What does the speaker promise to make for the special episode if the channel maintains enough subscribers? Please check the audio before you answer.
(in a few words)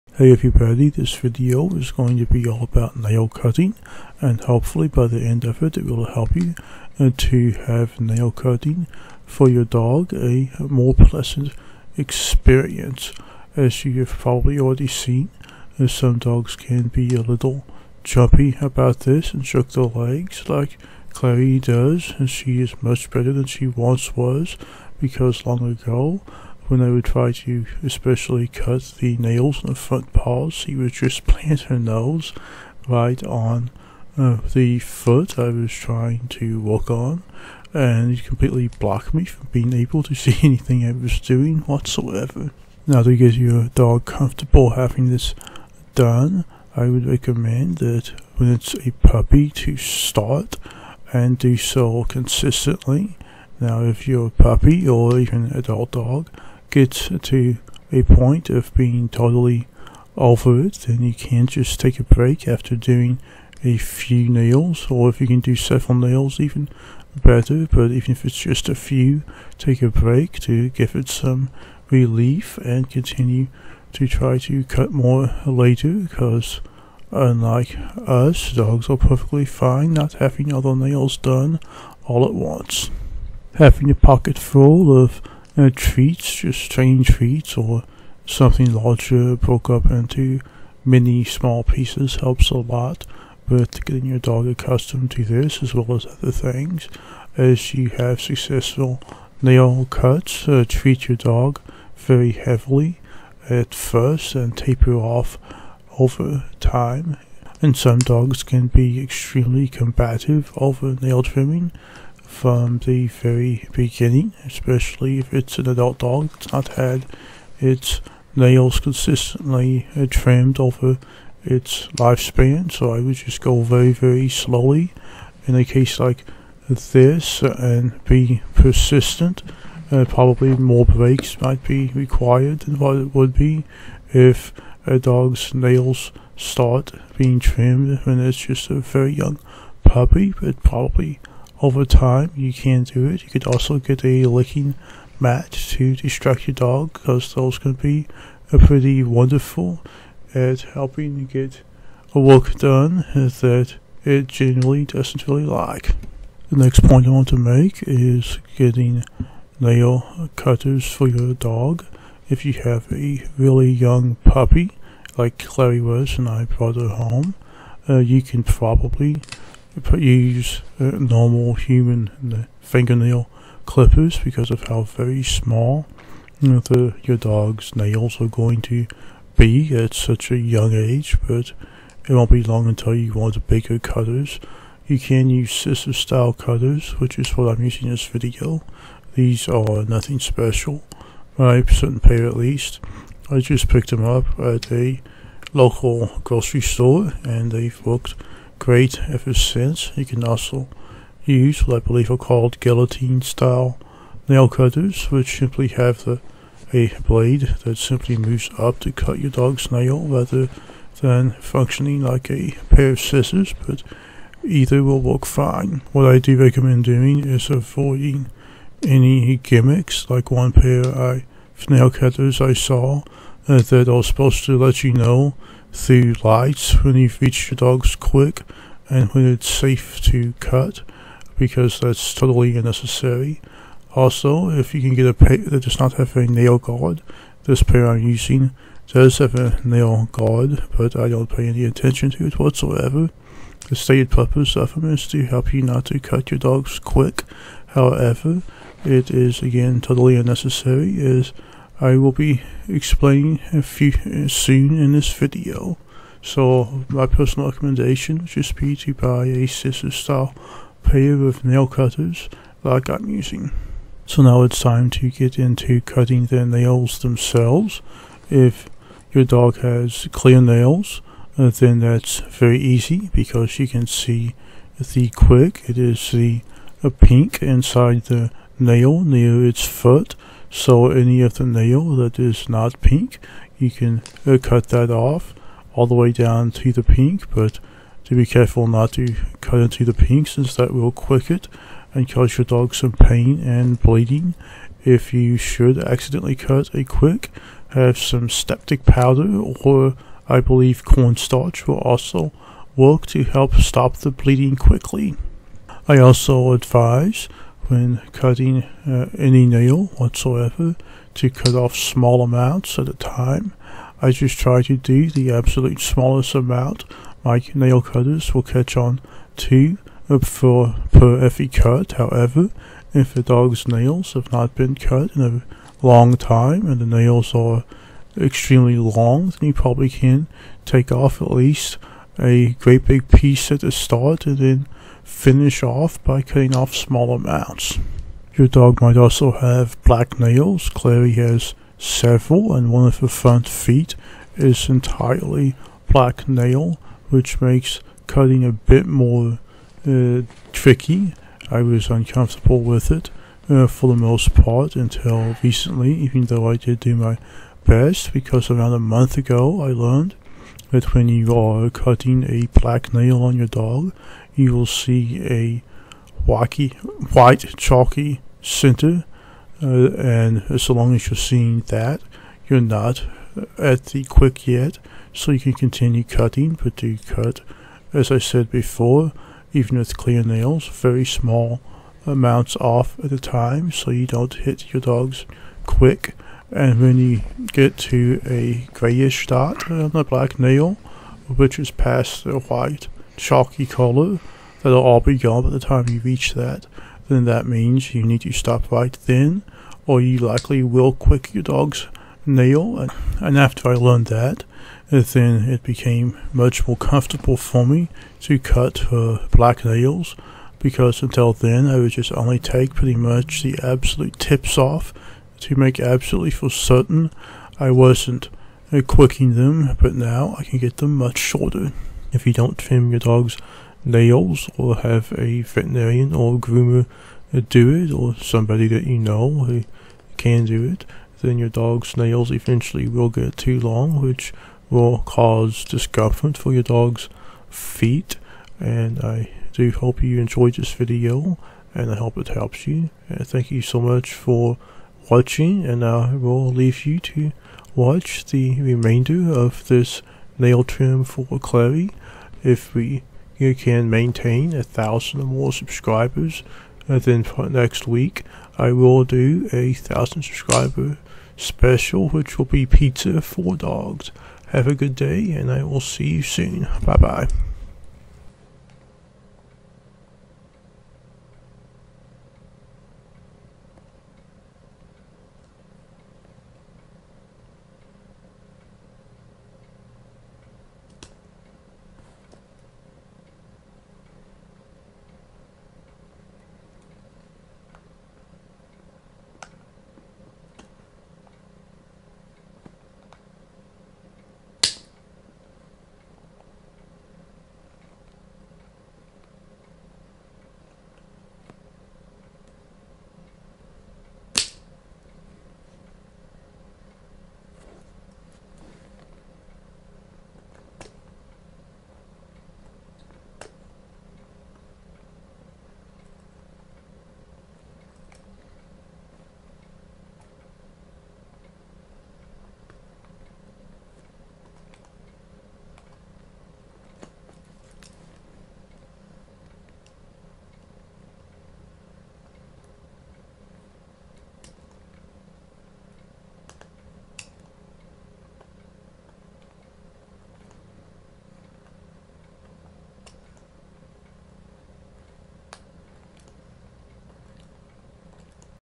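pizza for dogs.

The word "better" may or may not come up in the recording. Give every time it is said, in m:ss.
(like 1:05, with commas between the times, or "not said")
0:23, 1:07.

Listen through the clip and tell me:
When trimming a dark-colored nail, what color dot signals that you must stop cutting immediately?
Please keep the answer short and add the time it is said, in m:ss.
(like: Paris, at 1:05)
grayish, at 6:28.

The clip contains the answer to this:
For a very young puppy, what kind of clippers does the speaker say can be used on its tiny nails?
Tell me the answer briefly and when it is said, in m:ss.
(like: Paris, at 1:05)
human fingernail clippers, at 2:51.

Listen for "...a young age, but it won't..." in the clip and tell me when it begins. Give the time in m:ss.
3:00.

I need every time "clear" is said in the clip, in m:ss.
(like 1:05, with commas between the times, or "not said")
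4:30, 6:19.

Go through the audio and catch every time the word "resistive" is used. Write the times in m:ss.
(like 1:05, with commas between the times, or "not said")
not said.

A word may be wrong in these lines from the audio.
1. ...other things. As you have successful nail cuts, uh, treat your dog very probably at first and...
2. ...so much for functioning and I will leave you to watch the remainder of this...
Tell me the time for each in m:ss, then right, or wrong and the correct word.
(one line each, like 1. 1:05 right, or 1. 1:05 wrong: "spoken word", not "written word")
1. 1:36 wrong: "heavily", not "probably"
2. 7:23 wrong: "watching", not "functioning".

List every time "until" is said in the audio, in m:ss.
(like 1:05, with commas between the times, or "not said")
3:02, 5:54, 6:51.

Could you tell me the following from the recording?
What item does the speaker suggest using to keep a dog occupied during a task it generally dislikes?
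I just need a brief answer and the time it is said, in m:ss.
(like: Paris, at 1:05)
licking mat, at 2:24.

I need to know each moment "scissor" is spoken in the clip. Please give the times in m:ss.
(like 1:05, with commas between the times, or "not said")
3:05, 3:32, 4:19.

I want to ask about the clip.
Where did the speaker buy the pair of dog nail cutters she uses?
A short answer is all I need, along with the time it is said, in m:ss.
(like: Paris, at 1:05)
local grocery store, at 3:15.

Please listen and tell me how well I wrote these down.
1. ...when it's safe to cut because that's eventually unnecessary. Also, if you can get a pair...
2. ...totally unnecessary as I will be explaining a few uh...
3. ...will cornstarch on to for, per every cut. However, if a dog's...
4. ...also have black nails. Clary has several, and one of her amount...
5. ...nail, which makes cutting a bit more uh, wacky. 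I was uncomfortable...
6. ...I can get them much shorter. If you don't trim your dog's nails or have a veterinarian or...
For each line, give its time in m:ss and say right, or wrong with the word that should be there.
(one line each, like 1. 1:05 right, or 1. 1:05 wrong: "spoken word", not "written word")
1. 3:49 wrong: "totally", not "eventually"
2. 4:09 right
3. 5:18 wrong: "catch", not "cornstarch"
4. 5:38 wrong: "front", not "amount"
5. 5:46 wrong: "tricky", not "wacky"
6. 7:00 right.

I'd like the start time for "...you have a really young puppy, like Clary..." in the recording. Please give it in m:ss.
2:42.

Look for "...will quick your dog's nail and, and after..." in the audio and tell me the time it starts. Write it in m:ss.
6:40.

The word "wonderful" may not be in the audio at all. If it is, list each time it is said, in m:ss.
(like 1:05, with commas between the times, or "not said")
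2:29.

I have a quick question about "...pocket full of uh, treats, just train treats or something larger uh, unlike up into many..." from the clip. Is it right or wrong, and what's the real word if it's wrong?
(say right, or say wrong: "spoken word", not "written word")
wrong: "broke", not "unlike".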